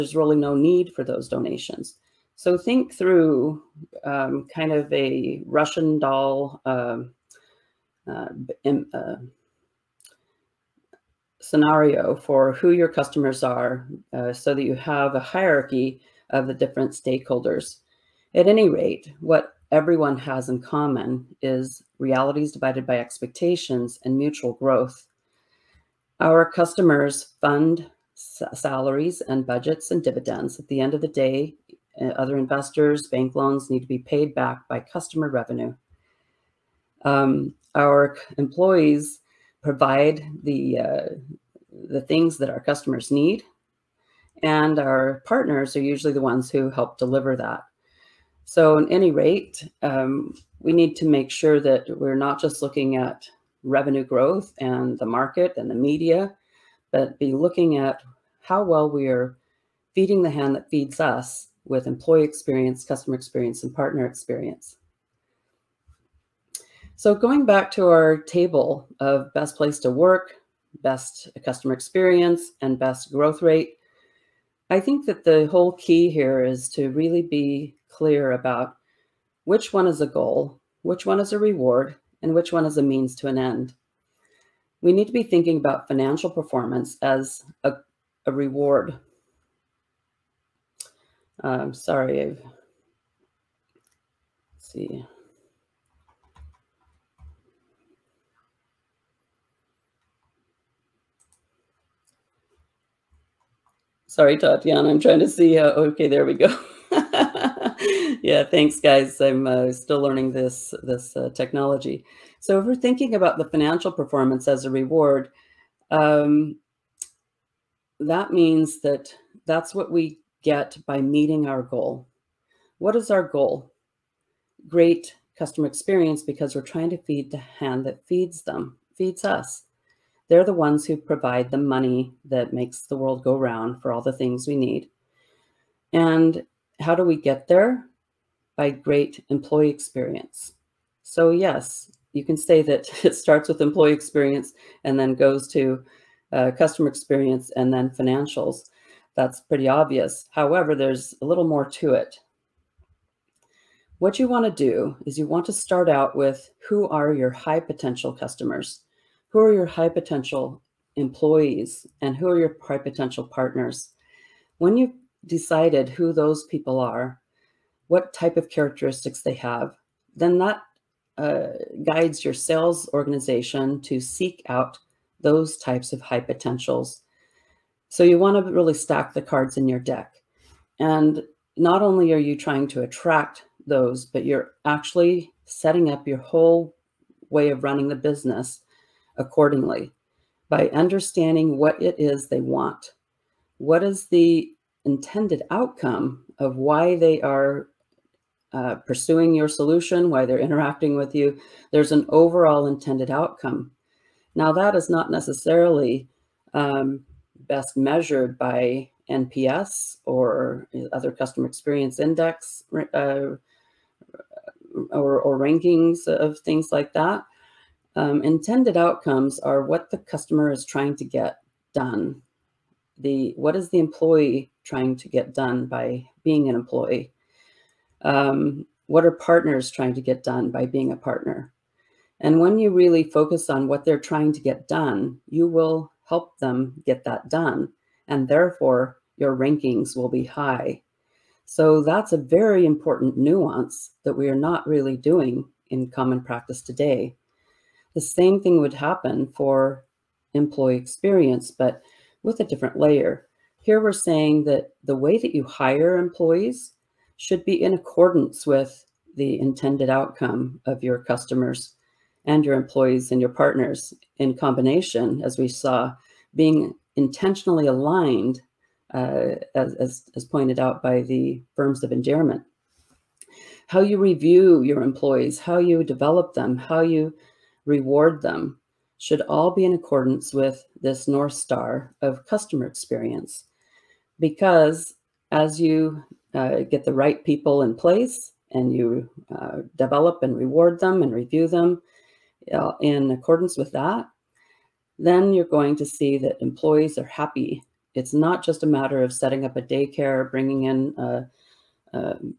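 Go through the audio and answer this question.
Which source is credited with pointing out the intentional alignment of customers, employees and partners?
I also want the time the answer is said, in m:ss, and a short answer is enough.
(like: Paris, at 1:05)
Firms of Endearment, at 4:31.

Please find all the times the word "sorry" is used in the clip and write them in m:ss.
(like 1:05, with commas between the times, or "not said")
1:31, 1:44.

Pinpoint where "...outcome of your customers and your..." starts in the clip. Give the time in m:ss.
4:19.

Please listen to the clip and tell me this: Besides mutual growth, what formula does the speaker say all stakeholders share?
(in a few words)
Realities divided by expectations.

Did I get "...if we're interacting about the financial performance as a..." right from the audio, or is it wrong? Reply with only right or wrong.
wrong.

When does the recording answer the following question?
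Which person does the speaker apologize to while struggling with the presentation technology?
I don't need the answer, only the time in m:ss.
1:44.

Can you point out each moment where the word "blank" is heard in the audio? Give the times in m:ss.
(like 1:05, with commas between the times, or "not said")
not said.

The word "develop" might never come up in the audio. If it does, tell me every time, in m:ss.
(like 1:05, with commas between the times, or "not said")
4:35, 4:49.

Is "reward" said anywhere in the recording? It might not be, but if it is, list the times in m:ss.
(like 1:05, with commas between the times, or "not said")
1:21, 1:28, 1:54, 4:37, 4:50.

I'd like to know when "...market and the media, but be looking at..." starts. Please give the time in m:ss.
0:55.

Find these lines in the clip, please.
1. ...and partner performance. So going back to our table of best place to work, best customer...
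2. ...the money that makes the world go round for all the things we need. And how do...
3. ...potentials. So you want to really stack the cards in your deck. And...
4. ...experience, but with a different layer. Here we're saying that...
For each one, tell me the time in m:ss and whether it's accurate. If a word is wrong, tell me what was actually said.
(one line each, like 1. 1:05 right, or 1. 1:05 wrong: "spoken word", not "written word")
1. 1:03 wrong: "experience", not "performance"
2. 2:11 right
3. 2:56 right
4. 4:10 right.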